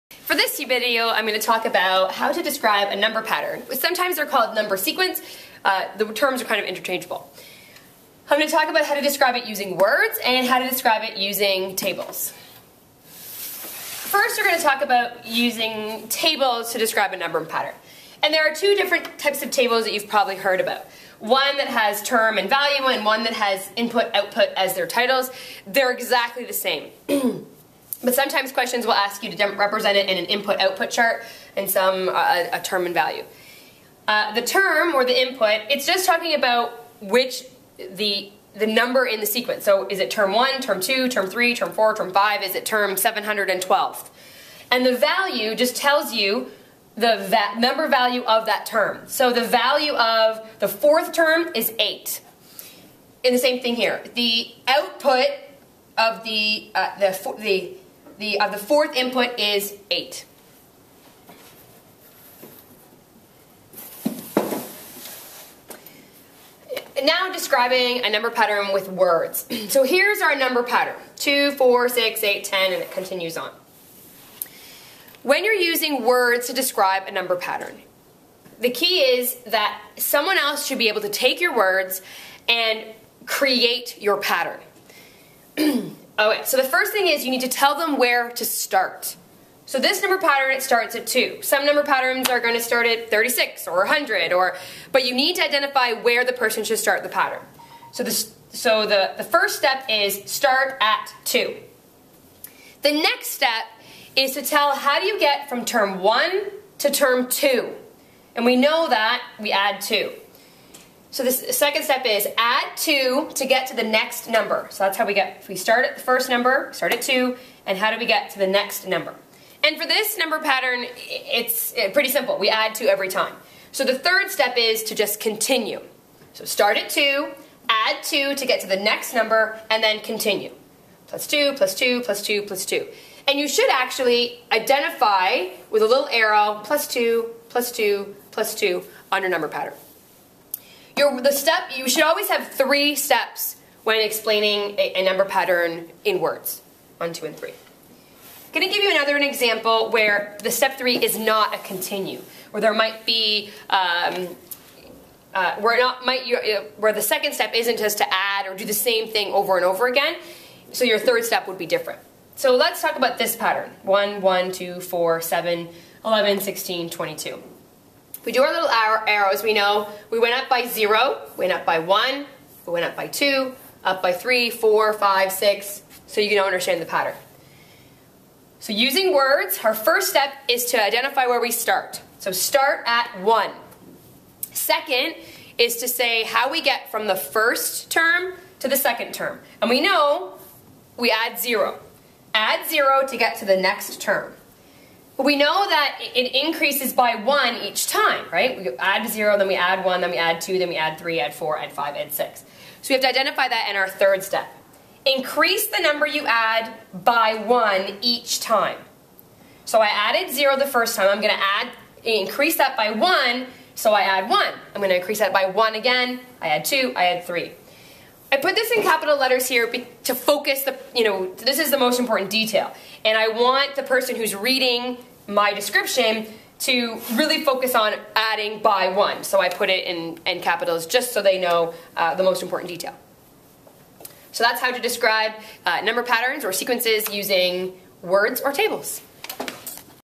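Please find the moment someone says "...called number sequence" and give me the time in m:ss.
0:04.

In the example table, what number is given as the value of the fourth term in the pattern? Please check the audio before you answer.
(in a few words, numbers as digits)
8.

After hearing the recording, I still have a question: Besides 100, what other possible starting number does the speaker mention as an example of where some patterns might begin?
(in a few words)
36.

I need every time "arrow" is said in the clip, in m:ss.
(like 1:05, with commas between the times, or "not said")
2:16, 2:48.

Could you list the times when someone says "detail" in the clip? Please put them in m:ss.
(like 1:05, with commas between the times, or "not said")
3:42, 3:52.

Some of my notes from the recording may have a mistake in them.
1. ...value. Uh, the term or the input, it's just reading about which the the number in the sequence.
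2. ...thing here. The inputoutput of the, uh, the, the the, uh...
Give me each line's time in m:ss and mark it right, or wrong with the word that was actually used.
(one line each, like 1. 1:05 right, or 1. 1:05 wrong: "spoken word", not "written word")
1. 0:32 wrong: "talking", not "reading"
2. 0:53 wrong: "output", not "inputoutput".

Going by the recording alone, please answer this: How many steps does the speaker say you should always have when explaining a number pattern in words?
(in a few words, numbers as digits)
3.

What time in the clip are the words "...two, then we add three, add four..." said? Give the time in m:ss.
3:20.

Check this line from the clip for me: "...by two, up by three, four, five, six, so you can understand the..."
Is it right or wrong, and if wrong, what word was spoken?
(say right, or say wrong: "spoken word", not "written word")
right.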